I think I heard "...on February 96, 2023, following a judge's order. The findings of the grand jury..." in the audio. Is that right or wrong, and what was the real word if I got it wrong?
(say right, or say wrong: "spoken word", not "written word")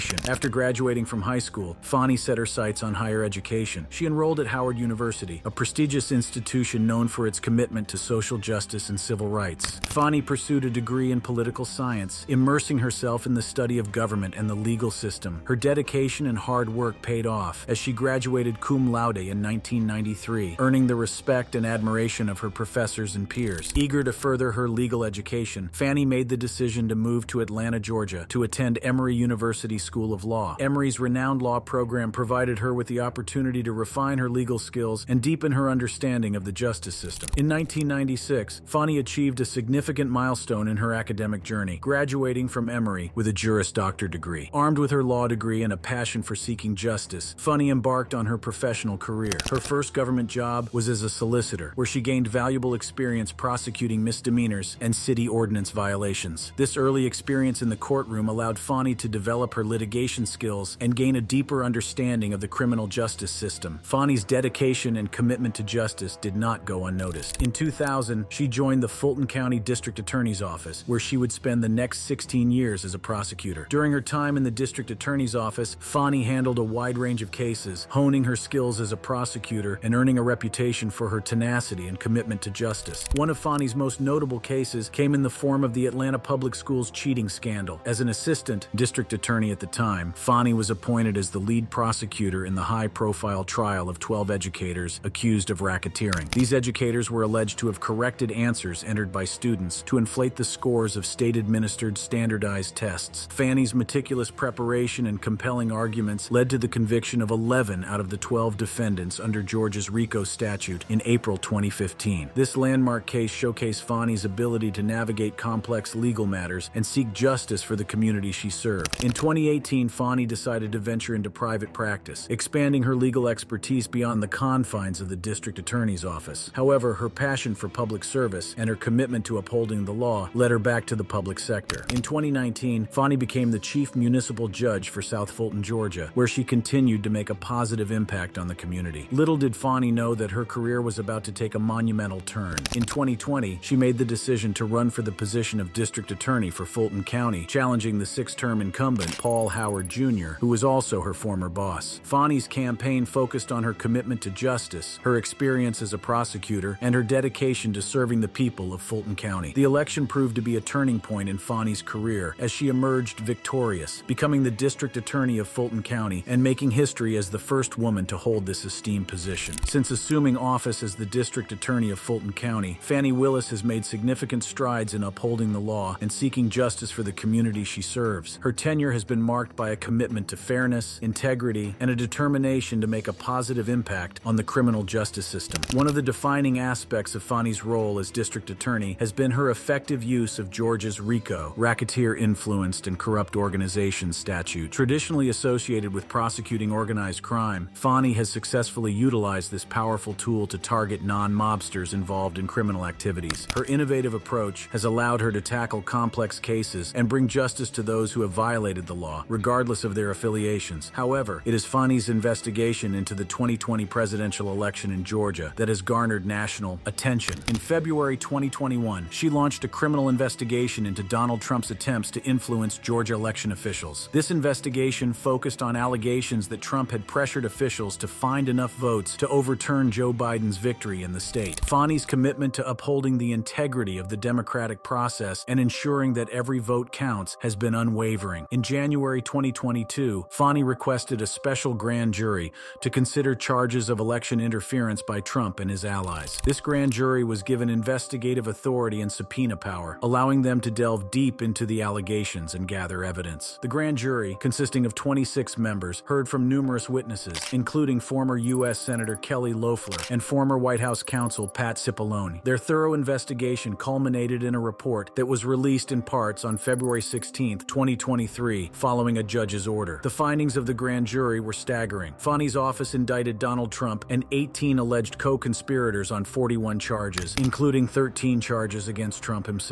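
wrong: "16", not "96".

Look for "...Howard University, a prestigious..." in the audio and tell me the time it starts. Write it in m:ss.
0:04.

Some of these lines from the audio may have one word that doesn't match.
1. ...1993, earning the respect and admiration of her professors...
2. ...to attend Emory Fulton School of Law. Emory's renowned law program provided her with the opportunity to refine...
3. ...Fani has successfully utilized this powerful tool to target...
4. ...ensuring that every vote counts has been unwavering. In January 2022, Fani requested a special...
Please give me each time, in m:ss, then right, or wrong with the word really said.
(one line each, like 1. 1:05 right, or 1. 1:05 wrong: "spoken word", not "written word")
1. 0:19 right
2. 0:28 wrong: "University", not "Fulton"
3. 3:17 right
4. 3:55 right.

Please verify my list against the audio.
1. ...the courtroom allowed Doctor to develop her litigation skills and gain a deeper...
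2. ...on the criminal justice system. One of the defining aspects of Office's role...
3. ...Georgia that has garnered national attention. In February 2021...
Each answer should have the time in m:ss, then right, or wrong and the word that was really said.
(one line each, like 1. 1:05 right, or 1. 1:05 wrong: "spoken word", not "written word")
1. 0:57 wrong: "Fani", not "Doctor"
2. 3:04 wrong: "Fani", not "Office"
3. 3:35 right.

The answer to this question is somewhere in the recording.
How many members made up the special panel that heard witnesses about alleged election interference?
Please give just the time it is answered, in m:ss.
4:14.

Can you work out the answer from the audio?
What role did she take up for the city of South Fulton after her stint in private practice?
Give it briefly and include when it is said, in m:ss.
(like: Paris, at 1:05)
chief municipal judge, at 2:13.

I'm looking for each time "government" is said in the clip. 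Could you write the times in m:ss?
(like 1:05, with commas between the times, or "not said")
0:13, 0:49.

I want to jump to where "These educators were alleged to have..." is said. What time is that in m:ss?
1:36.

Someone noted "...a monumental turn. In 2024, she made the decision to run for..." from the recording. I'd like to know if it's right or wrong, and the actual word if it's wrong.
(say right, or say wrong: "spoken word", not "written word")
wrong: "2020", not "2024".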